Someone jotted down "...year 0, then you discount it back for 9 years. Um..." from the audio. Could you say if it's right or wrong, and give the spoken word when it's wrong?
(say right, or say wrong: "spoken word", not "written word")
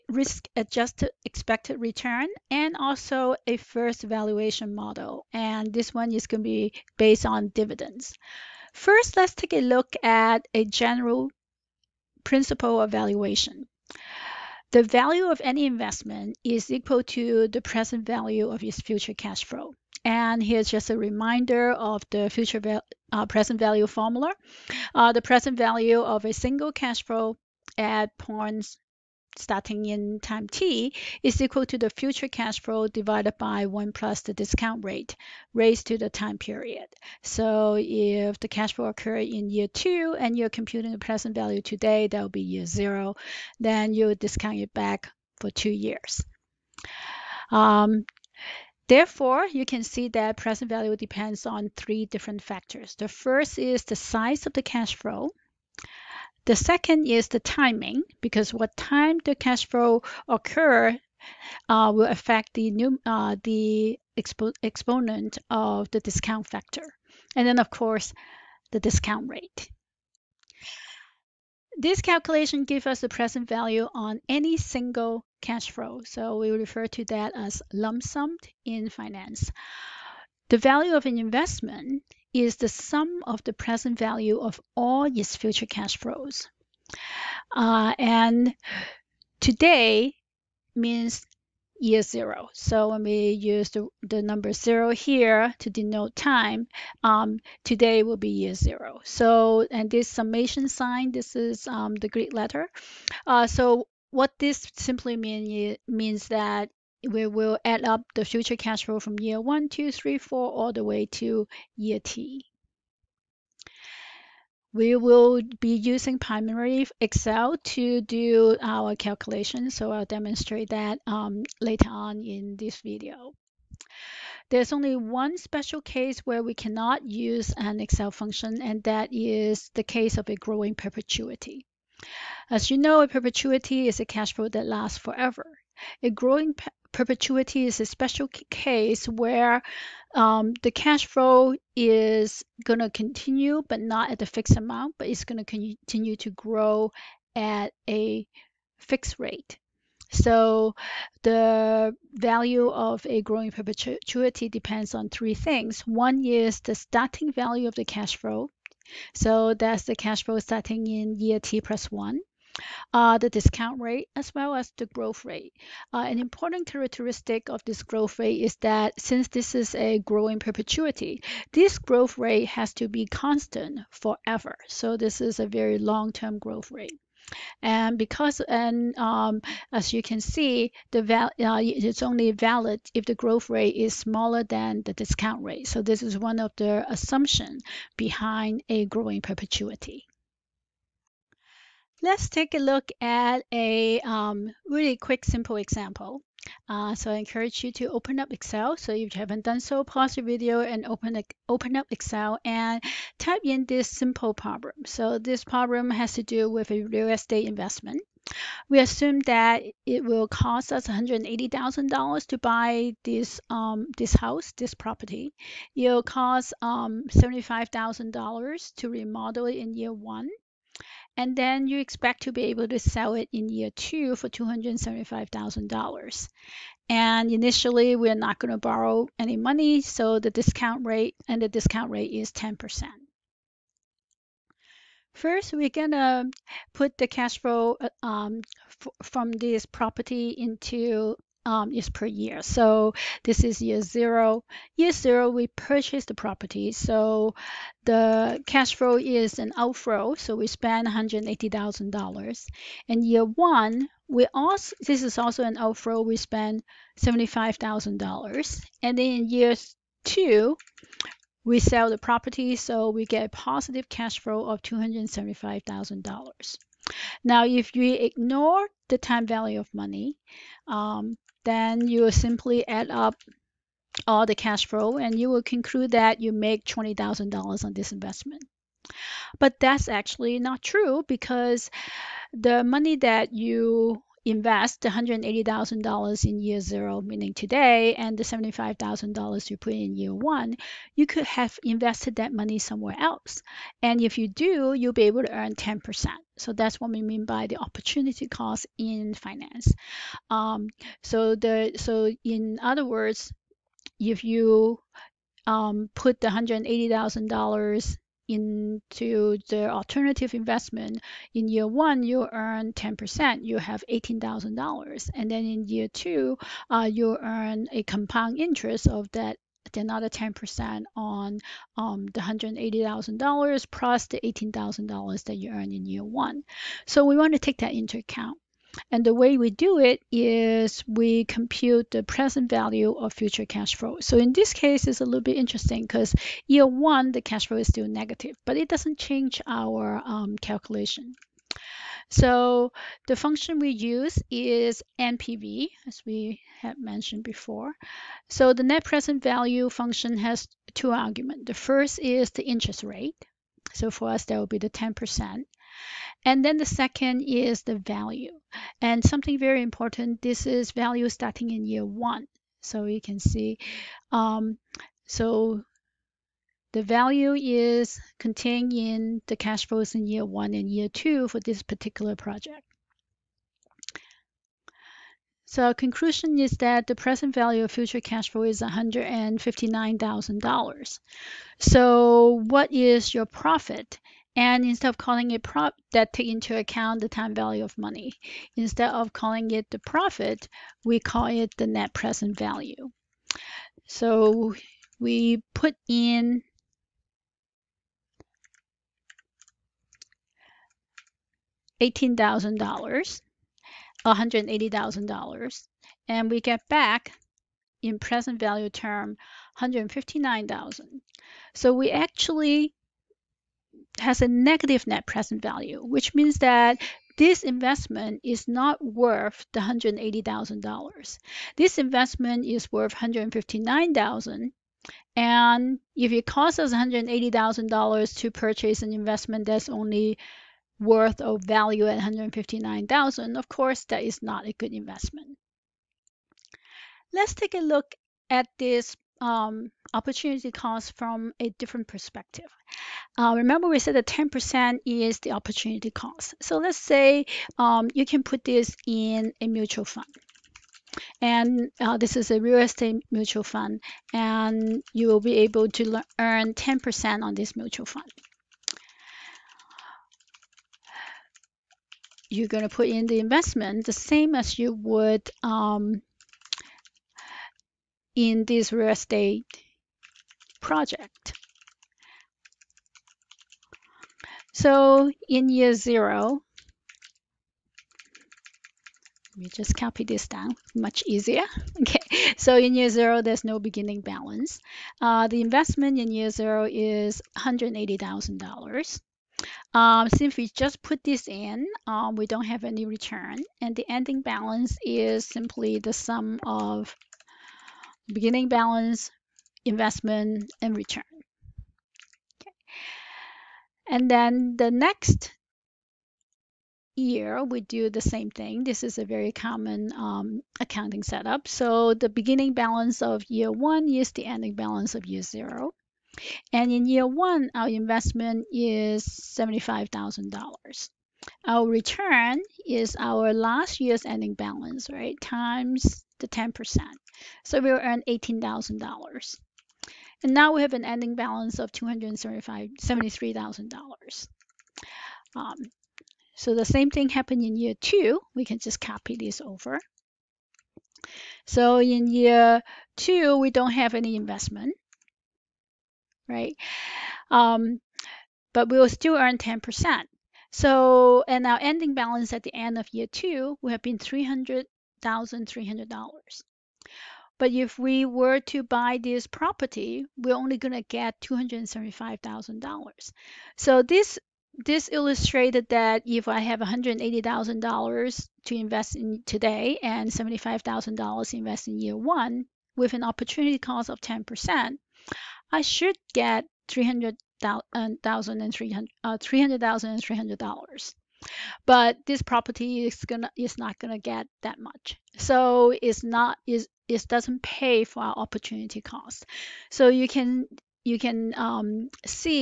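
wrong: "2", not "9".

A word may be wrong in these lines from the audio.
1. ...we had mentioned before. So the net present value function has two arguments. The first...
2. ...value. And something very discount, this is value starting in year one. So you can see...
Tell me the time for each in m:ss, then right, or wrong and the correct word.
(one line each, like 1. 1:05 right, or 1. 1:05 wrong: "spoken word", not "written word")
1. 5:46 right
2. 5:57 wrong: "important", not "discount".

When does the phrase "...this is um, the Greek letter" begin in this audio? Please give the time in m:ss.
1:41.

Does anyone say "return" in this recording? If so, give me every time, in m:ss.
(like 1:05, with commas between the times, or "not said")
0:01, 8:12, 8:20, 8:41.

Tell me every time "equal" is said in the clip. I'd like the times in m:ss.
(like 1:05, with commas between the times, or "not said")
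0:16, 0:31.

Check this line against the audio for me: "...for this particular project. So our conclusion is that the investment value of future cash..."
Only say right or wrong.
wrong.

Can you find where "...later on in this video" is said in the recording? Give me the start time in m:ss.
2:01.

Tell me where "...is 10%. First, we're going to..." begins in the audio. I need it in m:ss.
3:52.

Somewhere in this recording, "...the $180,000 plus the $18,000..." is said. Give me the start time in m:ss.
5:22.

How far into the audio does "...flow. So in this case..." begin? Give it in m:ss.
5:33.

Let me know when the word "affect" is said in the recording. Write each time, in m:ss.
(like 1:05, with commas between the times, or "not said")
1:02.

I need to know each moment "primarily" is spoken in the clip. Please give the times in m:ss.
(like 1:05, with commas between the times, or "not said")
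1:56.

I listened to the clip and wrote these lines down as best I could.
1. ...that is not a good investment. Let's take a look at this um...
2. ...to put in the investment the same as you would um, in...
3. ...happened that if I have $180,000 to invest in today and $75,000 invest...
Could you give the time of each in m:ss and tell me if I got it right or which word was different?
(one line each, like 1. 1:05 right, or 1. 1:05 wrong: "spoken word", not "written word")
1. 7:13 right
2. 7:42 right
3. 9:24 wrong: "illustrated", not "happened".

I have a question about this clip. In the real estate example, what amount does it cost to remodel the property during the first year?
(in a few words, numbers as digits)
$75,000.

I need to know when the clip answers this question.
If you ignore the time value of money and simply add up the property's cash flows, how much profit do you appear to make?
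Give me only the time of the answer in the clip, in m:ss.
4:36.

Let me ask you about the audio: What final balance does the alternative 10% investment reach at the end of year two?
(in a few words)
$300,300.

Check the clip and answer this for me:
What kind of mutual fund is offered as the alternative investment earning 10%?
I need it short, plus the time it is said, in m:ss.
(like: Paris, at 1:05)
real estate mutual fund, at 7:32.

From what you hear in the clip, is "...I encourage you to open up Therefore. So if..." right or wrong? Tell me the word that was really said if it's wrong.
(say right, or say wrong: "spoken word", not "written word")
wrong: "Excel", not "Therefore".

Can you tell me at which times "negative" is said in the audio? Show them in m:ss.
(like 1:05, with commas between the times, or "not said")
5:37, 6:54.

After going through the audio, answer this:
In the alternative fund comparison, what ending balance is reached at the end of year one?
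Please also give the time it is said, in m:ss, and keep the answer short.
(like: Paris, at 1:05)
$273,000, at 8:51.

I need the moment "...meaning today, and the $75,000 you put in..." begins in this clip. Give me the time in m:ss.
4:47.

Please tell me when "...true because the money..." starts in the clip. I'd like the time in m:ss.
4:40.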